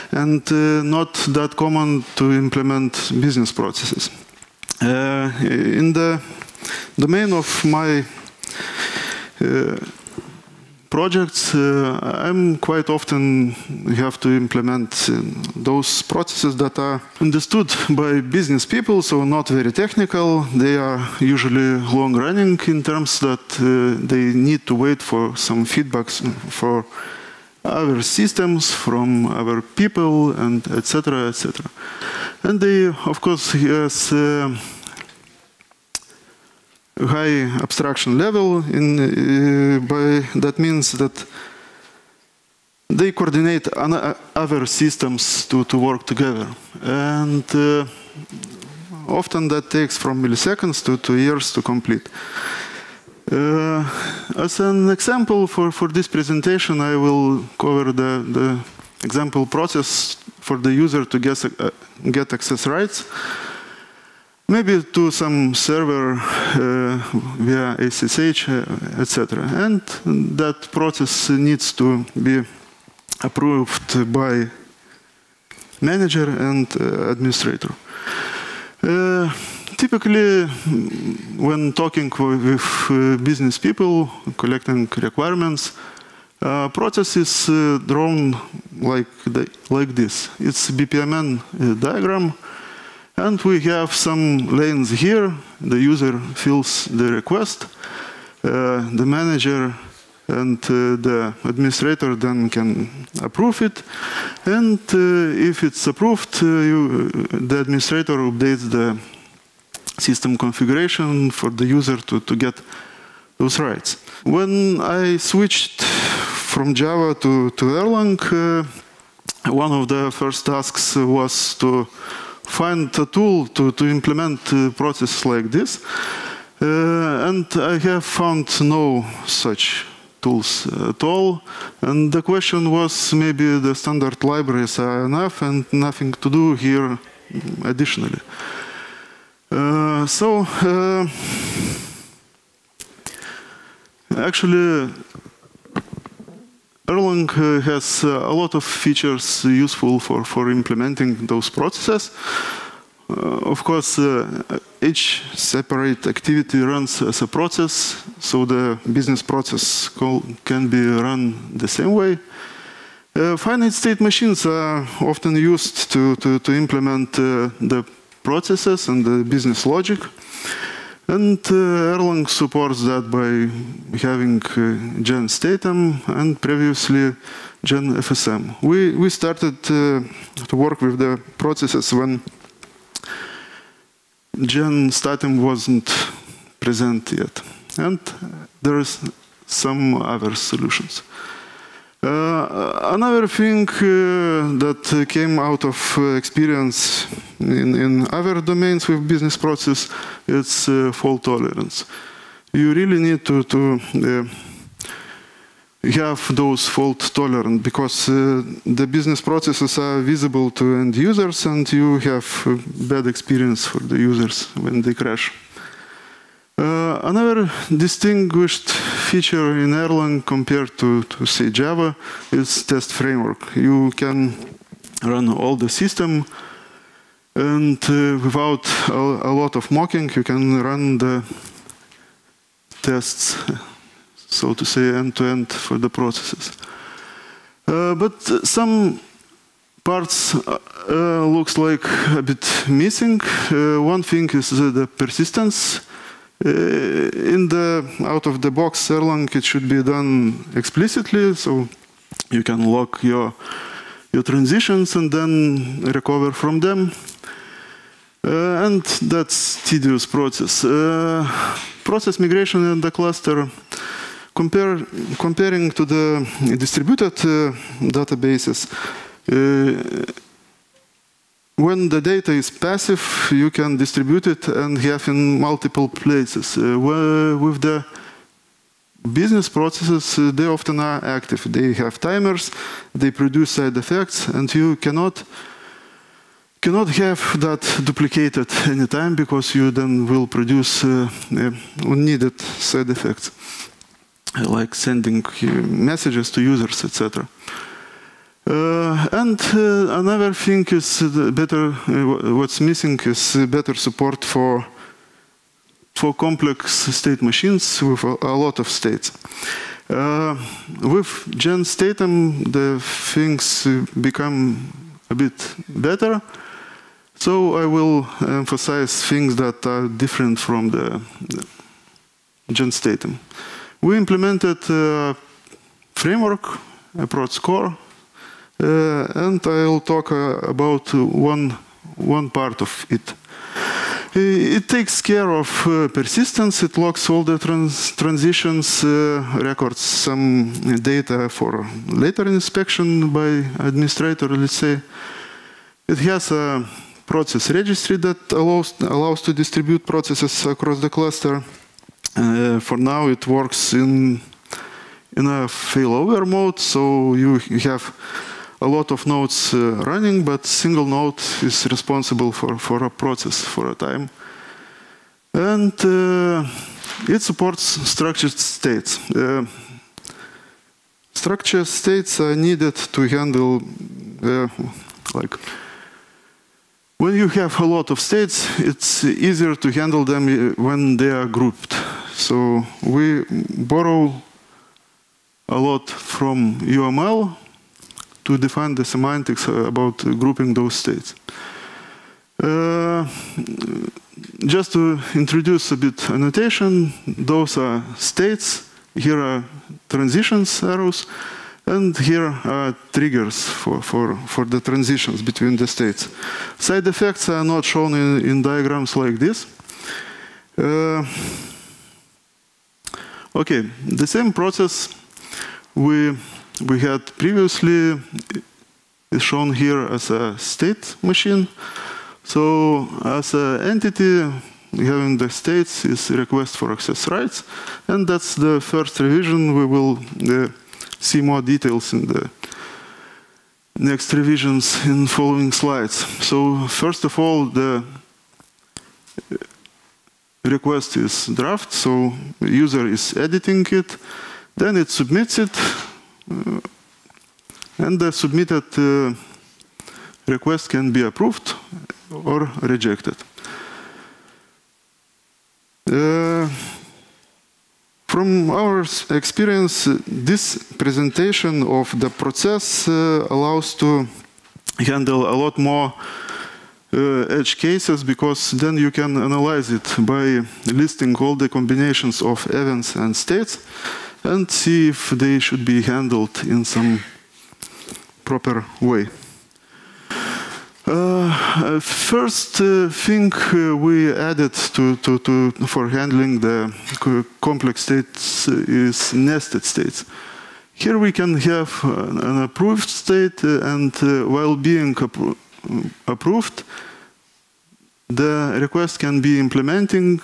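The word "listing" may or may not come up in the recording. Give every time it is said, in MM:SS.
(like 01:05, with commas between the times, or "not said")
07:50.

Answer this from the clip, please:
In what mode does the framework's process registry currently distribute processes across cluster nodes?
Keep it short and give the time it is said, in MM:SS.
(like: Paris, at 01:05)
failover mode, at 05:55.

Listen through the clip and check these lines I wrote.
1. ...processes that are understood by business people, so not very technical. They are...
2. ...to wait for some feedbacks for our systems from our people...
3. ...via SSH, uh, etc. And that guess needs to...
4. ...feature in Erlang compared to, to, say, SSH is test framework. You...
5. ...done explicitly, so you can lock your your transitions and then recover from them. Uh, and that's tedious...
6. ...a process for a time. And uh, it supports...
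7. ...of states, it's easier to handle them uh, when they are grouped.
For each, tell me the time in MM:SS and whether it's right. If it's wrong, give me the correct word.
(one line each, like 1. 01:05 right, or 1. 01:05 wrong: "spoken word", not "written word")
1. 00:16 right
2. 00:24 right
3. 01:07 wrong: "process", not "guess"
4. 03:39 wrong: "Java", not "SSH"
5. 04:09 right
6. 06:02 right
7. 06:17 right.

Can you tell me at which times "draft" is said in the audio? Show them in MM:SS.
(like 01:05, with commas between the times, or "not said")
07:21.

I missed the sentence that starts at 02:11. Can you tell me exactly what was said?
And the question was maybe the standard libraries are enough and nothing to do here mm, additionally.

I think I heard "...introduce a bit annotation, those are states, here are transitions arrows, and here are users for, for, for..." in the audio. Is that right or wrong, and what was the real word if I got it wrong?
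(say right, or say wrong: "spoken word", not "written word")
wrong: "triggers", not "users".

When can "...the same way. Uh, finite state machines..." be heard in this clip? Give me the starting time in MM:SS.
02:41.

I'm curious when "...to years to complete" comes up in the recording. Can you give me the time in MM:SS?
00:50.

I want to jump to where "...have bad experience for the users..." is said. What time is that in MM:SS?
03:32.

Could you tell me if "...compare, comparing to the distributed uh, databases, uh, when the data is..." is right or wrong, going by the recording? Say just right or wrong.
right.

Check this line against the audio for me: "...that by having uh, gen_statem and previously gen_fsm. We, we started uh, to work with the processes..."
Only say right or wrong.
right.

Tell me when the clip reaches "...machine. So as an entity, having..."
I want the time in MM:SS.
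07:01.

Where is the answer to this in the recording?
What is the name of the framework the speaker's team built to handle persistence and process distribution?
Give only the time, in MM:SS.
05:26.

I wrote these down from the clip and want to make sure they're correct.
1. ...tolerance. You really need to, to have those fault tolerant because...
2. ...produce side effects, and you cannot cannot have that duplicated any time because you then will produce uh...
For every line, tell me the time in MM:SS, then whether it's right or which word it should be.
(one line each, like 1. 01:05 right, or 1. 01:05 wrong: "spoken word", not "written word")
1. 03:21 right
2. 04:43 right.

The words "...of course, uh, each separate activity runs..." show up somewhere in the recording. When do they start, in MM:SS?
02:33.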